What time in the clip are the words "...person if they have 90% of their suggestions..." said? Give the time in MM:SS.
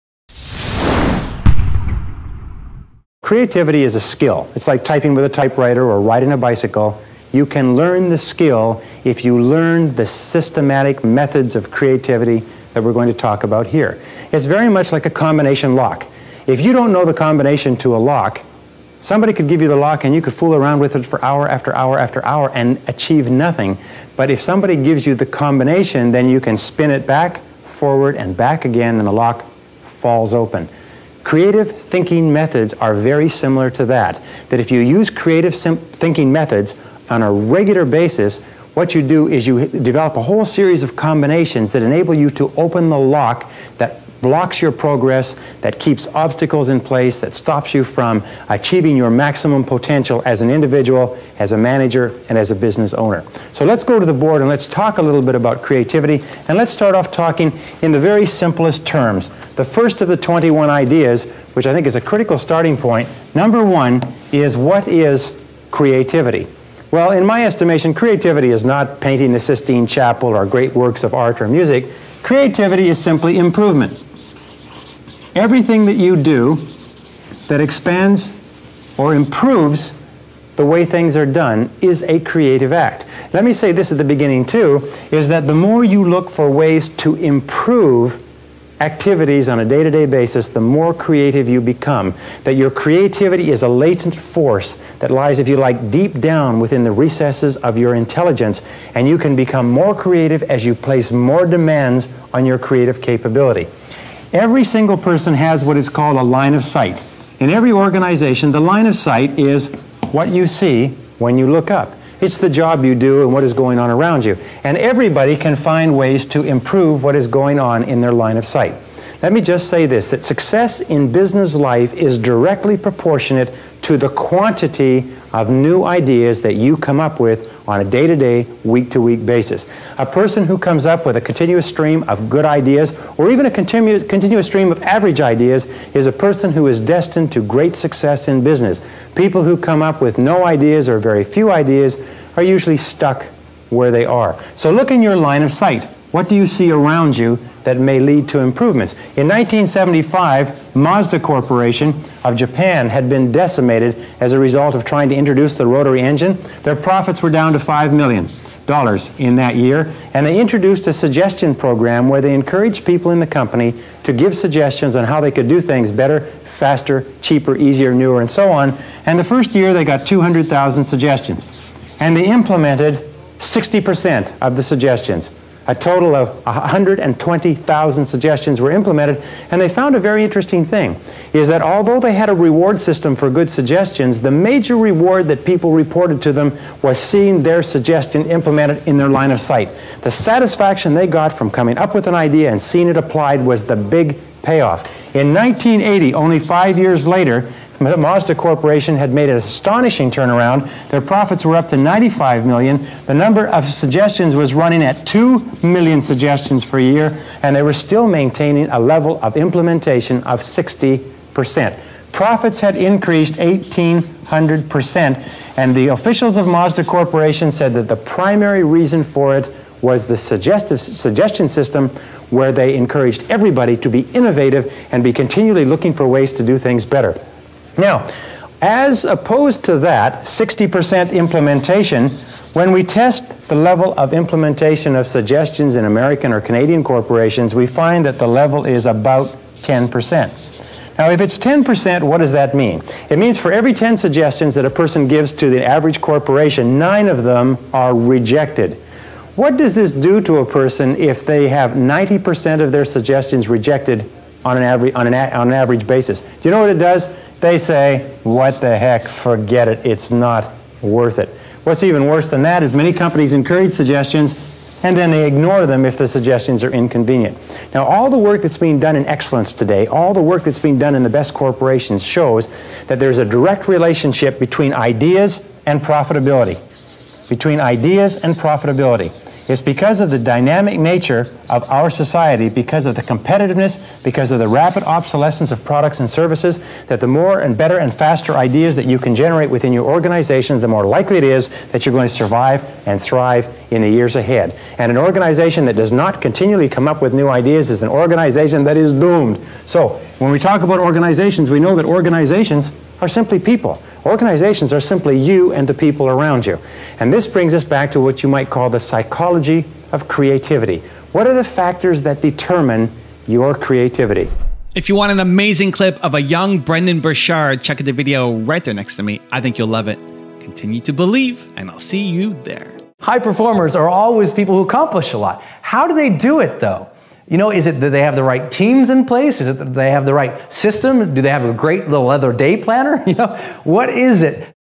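04:10.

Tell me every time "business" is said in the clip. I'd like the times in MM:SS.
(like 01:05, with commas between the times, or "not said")
00:52, 02:01, 02:18.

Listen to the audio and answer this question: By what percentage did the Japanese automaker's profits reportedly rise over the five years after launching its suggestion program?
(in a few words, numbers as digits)
1,800%.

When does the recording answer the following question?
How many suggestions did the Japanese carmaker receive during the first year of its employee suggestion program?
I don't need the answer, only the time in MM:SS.
02:50.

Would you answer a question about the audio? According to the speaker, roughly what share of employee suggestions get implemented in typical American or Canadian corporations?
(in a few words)
10%.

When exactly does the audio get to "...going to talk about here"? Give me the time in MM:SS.
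00:12.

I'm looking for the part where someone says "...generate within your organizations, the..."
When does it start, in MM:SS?
04:49.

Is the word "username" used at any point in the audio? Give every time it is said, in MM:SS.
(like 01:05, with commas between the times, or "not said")
not said.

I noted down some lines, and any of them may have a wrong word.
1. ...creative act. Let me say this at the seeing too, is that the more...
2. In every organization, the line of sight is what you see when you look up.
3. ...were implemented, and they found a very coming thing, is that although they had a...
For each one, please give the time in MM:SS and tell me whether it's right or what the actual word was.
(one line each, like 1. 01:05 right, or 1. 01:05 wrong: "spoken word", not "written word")
1. 01:22 wrong: "beginning", not "seeing"
2. 01:47 right
3. 02:58 wrong: "interesting", not "coming".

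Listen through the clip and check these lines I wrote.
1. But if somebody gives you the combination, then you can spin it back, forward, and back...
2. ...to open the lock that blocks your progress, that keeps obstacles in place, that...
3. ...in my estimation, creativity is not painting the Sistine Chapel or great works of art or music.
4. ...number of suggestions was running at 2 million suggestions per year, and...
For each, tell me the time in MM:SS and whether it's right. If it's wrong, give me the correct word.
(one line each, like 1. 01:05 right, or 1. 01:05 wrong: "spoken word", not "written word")
1. 00:24 right
2. 00:42 right
3. 01:07 right
4. 03:23 right.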